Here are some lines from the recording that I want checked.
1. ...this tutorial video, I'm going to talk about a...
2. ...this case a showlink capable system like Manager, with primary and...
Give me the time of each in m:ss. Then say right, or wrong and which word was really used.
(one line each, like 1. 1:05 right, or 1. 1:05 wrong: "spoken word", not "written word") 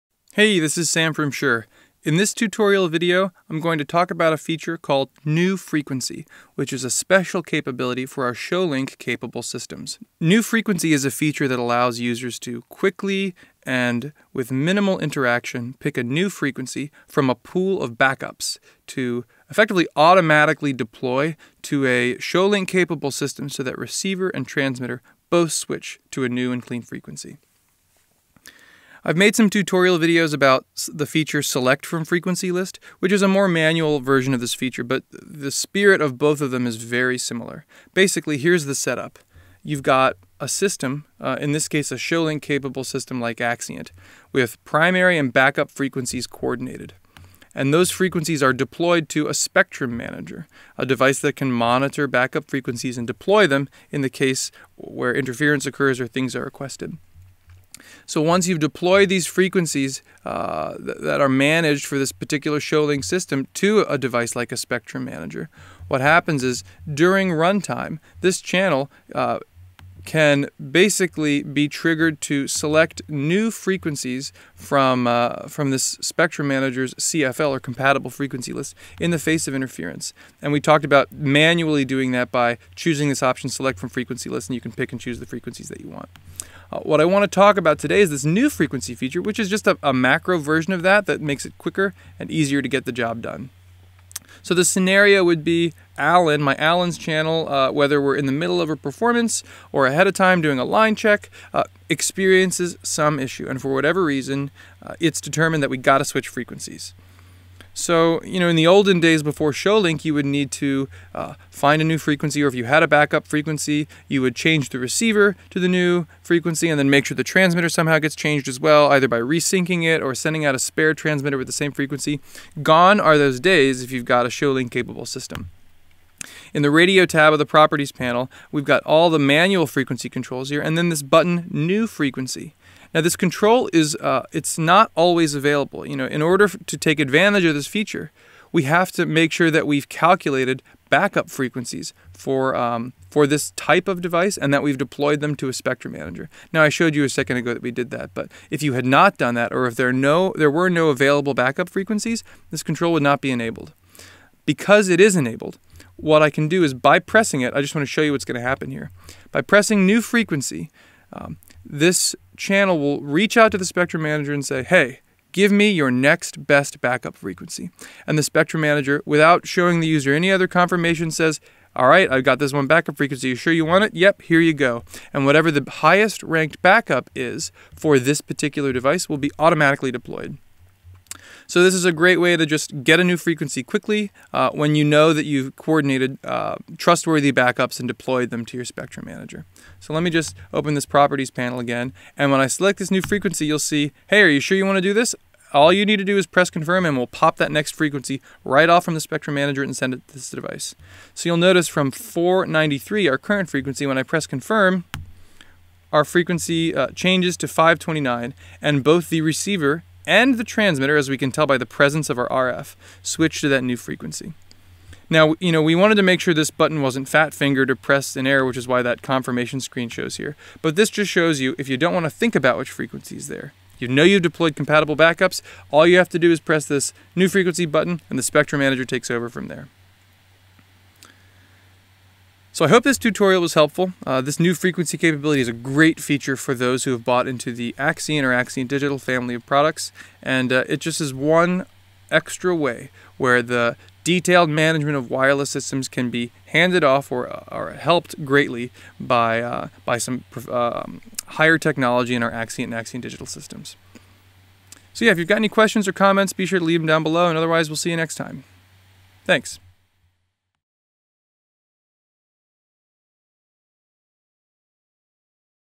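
1. 0:02 right
2. 0:41 wrong: "Axient", not "Manager".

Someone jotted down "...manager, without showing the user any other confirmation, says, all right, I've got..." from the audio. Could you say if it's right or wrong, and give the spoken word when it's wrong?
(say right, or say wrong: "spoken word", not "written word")
right.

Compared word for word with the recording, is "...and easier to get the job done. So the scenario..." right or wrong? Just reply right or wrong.
right.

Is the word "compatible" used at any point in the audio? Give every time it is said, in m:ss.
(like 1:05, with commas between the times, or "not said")
1:17, 3:44.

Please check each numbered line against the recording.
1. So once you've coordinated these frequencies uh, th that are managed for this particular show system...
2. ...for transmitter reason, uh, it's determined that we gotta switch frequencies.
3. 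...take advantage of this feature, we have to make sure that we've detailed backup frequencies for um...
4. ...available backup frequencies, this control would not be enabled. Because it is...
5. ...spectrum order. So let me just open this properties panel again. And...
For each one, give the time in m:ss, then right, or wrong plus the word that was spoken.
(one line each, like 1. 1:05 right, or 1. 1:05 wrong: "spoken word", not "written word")
1. 0:58 wrong: "deployed", not "coordinated"
2. 1:43 wrong: "whatever", not "transmitter"
3. 2:16 wrong: "calculated", not "detailed"
4. 2:30 right
5. 3:08 wrong: "manager", not "order".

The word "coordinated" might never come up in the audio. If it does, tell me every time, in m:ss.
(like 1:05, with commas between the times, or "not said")
0:46, 3:05.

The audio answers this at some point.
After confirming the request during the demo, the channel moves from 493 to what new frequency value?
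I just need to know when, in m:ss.
3:27.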